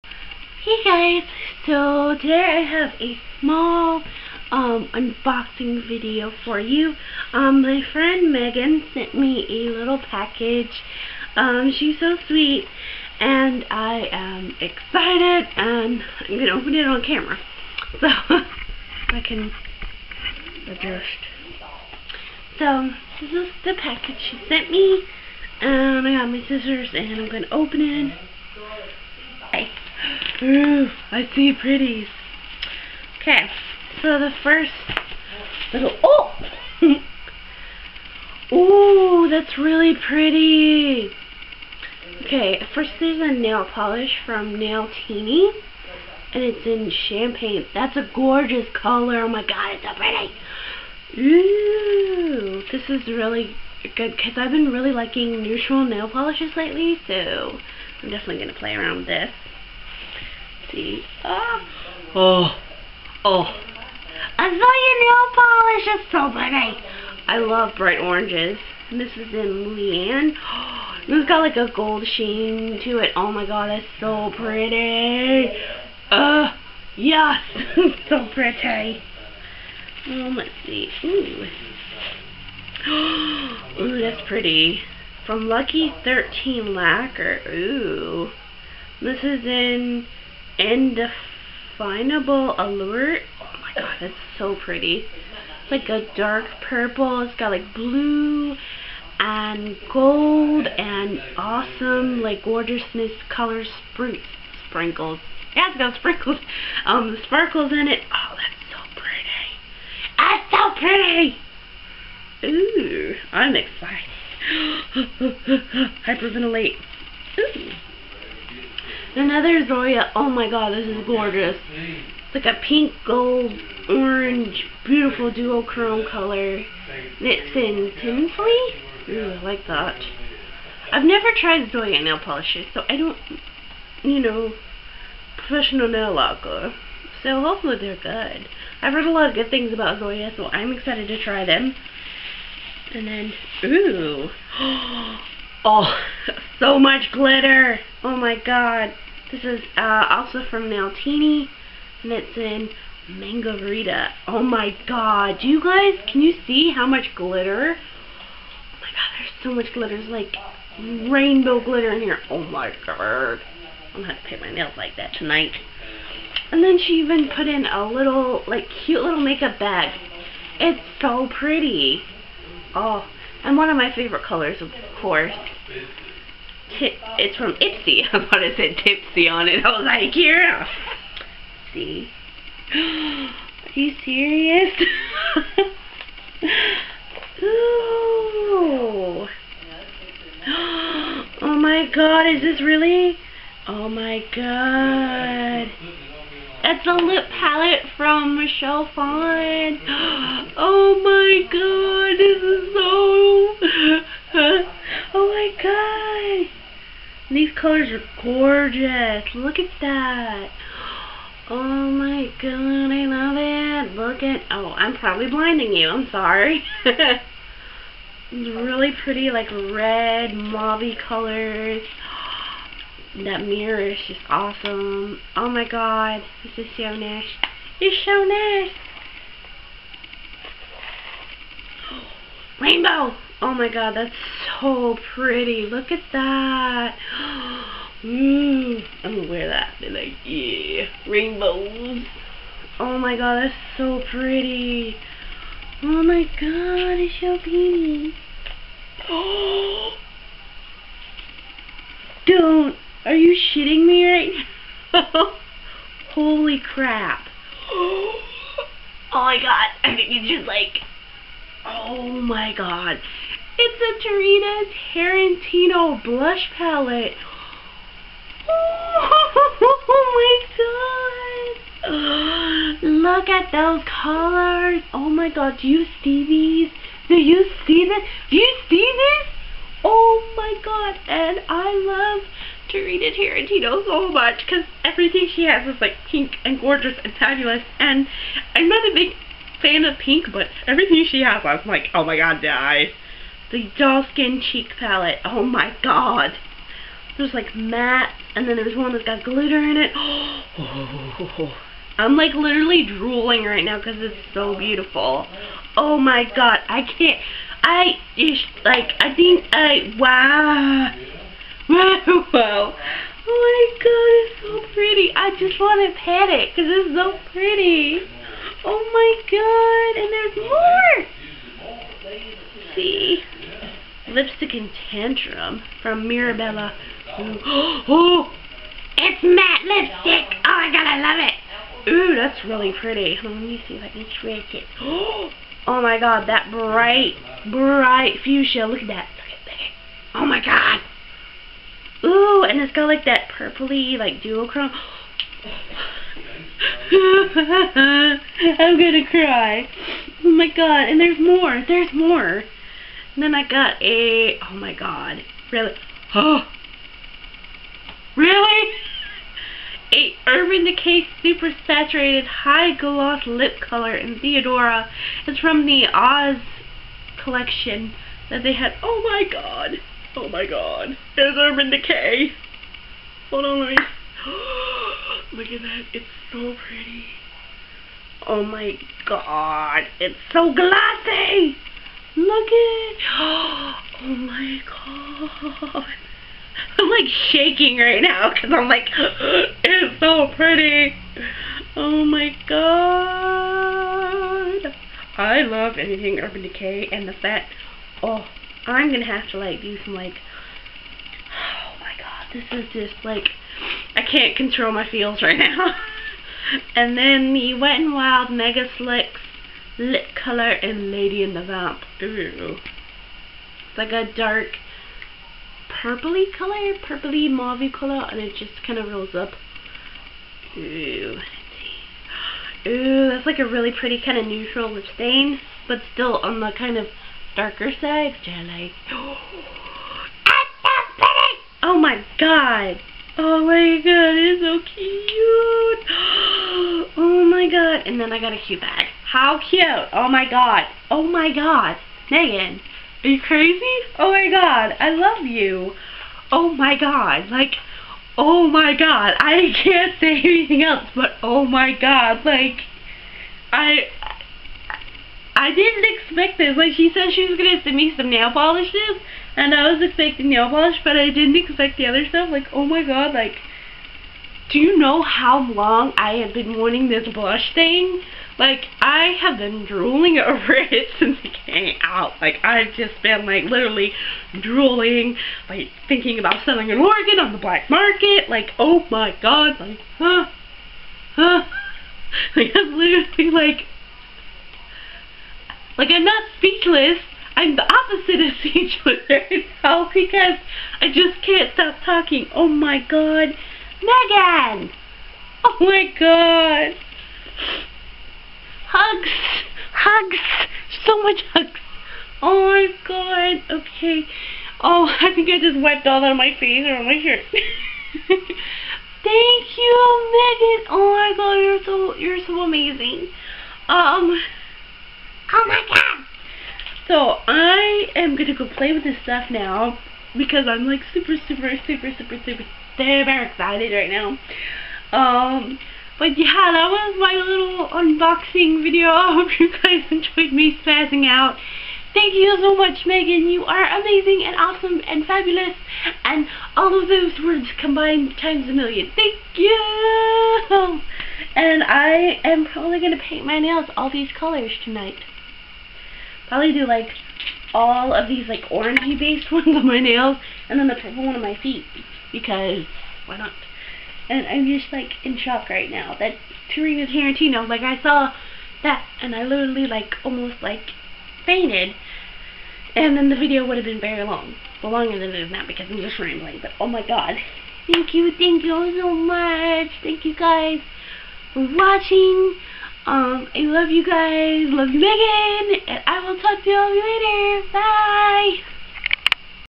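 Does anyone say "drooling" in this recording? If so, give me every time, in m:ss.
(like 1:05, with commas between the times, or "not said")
5:02, 7:49, 7:54.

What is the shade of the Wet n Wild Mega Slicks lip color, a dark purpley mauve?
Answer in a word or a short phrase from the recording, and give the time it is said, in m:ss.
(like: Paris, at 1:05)
Lady and the Vamp, at 6:50.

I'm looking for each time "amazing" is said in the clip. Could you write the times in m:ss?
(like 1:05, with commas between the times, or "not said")
8:32, 8:53.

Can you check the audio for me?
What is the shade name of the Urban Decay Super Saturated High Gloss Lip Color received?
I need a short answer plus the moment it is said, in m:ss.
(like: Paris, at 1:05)
Theodora, at 6:04.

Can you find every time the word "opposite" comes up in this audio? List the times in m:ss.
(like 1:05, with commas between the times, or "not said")
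8:07.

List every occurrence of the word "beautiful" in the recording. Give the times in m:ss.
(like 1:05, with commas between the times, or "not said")
2:04, 5:04.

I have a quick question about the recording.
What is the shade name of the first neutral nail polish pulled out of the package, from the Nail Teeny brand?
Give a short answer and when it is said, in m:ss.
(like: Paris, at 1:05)
Champagne, at 0:46.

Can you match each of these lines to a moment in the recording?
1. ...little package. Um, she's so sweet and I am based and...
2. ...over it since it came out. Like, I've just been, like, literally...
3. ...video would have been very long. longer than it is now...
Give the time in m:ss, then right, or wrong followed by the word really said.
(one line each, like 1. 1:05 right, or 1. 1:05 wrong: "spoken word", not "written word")
1. 0:09 wrong: "excited", not "based"
2. 7:50 right
3. 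9:23 right.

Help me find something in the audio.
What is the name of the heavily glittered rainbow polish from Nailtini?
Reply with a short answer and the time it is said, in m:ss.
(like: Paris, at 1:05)
Mangarita, at 2:33.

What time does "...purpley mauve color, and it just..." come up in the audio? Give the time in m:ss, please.
6:56.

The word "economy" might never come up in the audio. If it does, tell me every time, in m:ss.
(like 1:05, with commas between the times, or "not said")
not said.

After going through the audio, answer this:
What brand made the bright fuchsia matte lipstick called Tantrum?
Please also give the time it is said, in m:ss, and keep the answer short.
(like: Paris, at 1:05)
Mirabella, at 5:26.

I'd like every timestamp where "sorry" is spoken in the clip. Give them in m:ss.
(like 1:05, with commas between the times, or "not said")
3:36.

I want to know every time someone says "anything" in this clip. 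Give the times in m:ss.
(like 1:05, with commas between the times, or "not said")
6:35, 7:30.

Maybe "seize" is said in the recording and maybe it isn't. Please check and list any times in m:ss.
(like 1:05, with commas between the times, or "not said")
not said.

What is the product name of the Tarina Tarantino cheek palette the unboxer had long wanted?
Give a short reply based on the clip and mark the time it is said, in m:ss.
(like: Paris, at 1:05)
Doll Skin Cheek Palette, at 4:53.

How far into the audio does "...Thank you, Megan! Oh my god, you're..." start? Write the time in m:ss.
8:28.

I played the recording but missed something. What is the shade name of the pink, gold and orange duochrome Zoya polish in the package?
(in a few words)
Tinsley.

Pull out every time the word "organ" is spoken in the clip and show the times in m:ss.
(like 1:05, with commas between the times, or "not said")
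7:56.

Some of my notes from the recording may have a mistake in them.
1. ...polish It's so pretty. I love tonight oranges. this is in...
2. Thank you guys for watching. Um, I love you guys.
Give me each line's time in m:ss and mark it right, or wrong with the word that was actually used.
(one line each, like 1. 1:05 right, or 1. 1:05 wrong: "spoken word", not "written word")
1. 1:05 wrong: "bright", not "tonight"
2. 9:29 right.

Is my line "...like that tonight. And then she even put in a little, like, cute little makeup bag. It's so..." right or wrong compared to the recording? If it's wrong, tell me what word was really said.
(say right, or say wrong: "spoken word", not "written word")
right.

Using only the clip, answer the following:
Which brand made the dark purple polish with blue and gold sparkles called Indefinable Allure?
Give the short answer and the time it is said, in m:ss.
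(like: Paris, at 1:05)
Lucky 13 Lacquer, at 1:25.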